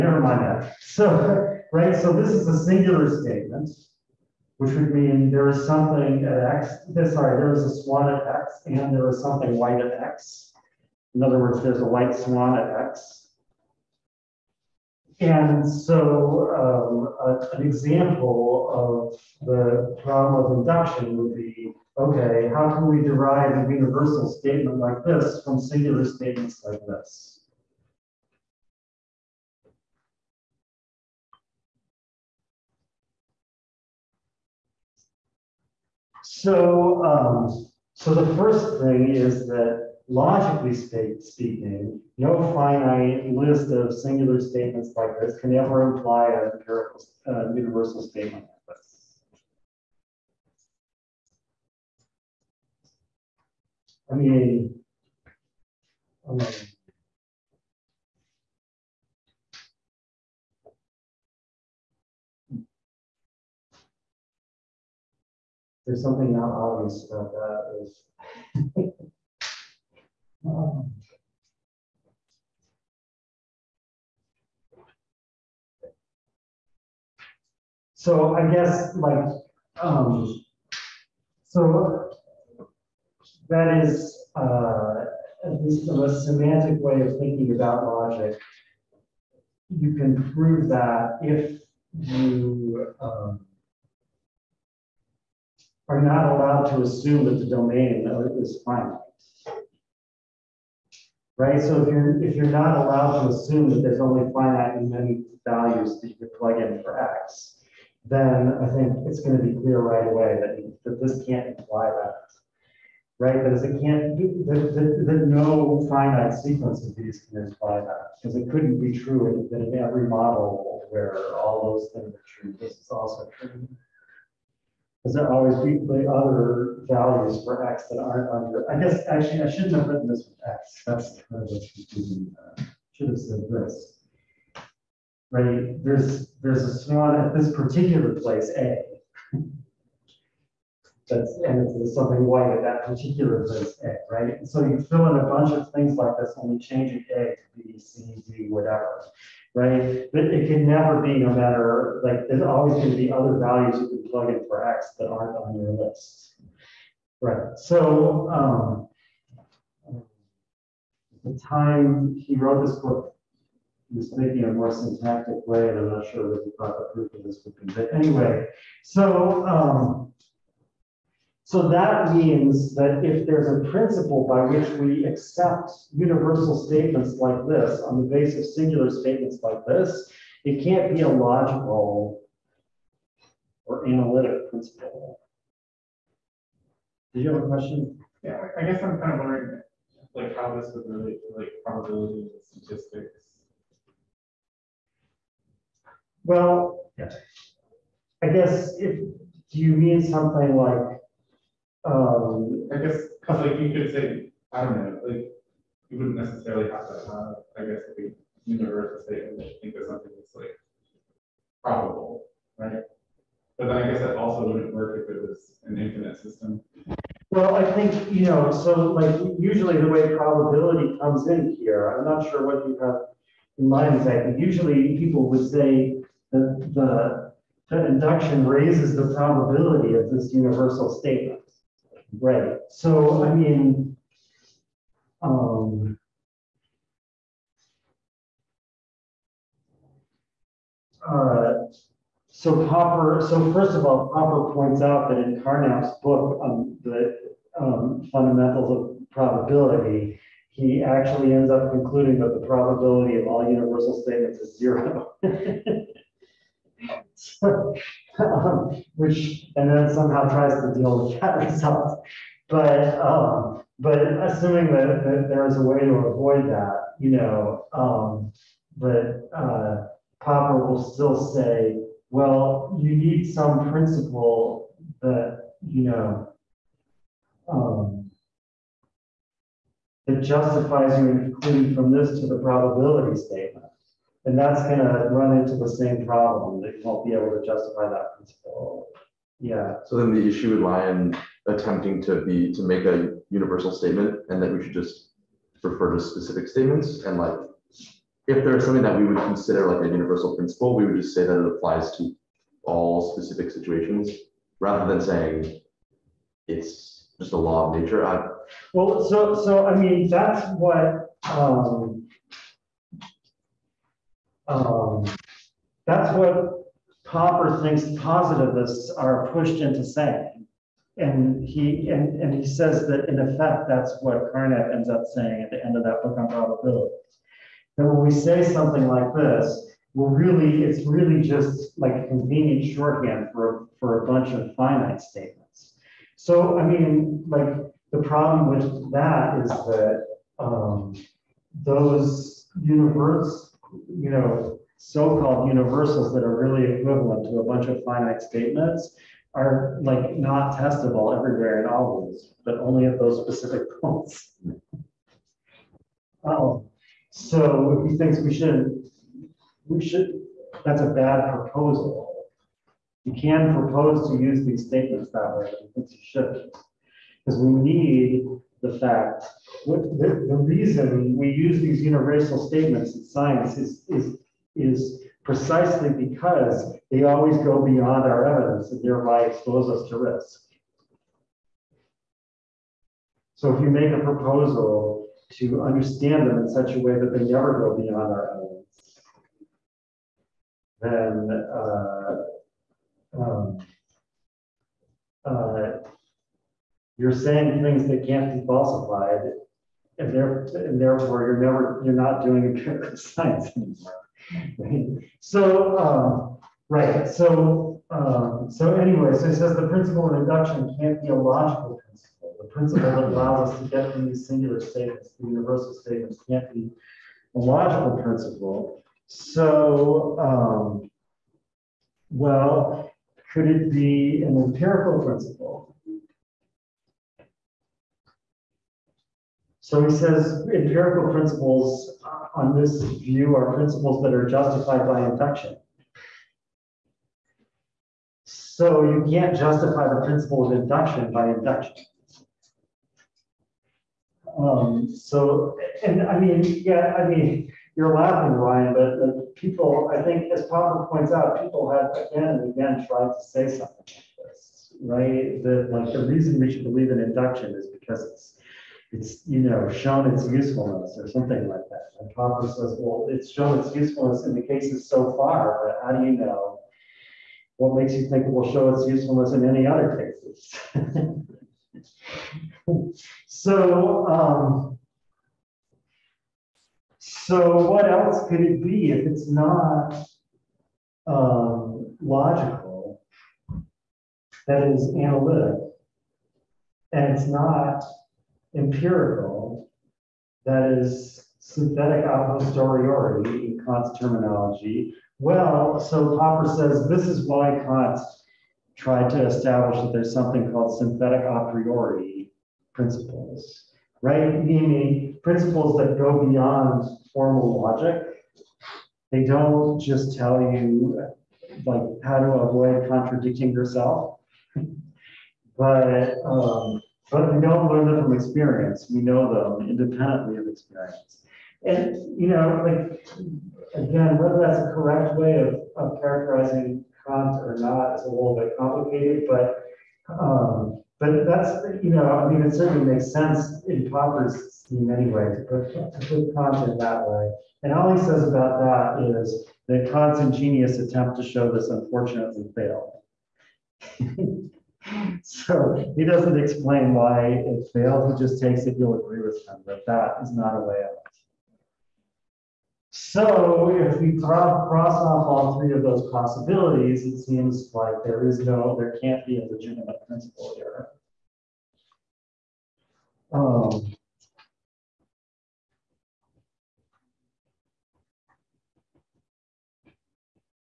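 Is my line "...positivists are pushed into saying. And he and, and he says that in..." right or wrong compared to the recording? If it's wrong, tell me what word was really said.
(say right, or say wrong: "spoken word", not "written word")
right.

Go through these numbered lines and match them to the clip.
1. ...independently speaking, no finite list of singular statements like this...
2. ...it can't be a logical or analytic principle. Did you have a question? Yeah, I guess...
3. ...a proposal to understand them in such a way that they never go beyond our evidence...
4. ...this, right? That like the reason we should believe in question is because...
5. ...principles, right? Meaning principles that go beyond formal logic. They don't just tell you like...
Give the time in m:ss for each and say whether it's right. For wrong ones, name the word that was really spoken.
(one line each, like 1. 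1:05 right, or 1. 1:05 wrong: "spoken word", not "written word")
1. 0:40 wrong: "logically", not "independently"
2. 3:00 right
3. 6:23 right
4. 7:34 wrong: "induction", not "question"
5. 8:22 right.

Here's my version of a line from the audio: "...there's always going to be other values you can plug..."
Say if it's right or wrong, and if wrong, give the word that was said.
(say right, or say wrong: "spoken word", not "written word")
right.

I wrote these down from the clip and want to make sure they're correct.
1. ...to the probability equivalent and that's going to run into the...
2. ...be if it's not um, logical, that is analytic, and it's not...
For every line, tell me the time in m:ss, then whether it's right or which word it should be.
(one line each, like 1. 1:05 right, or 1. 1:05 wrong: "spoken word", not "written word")
1. 4:42 wrong: "statement", not "equivalent"
2. 7:58 right.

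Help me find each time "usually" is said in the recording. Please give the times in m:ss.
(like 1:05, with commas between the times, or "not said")
3:39, 3:44.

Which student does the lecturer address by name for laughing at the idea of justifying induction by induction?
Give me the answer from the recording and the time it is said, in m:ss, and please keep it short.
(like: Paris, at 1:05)
Ryan, at 7:28.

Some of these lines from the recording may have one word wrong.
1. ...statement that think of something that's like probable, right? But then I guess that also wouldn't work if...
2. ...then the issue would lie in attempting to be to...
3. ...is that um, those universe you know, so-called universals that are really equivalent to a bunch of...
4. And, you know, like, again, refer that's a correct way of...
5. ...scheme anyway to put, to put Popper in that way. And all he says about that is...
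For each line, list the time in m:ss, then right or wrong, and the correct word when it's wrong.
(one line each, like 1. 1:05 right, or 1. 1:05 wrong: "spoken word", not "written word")
1. 3:29 right
2. 4:49 right
3. 5:39 right
4. 8:41 wrong: "whether", not "refer"
5. 8:54 wrong: "Kant", not "Popper".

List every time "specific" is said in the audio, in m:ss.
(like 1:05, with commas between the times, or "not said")
4:56, 5:03, 5:53.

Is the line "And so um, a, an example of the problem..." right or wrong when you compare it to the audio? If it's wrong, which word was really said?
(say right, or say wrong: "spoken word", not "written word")
right.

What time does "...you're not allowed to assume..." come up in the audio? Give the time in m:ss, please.
1:42.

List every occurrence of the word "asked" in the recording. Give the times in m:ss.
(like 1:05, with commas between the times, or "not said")
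not said.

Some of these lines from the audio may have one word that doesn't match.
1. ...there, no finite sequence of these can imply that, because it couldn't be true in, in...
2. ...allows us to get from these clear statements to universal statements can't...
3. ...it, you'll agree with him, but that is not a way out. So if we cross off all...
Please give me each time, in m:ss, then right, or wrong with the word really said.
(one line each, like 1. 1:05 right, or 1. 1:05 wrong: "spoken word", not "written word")
1. 1:55 right
2. 6:53 wrong: "singular", not "clear"
3. 9:08 right.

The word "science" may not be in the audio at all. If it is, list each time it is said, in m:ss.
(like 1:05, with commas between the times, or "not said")
6:13, 6:42.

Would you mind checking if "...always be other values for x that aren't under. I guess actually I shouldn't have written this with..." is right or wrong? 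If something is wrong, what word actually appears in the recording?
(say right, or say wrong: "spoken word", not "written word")
right.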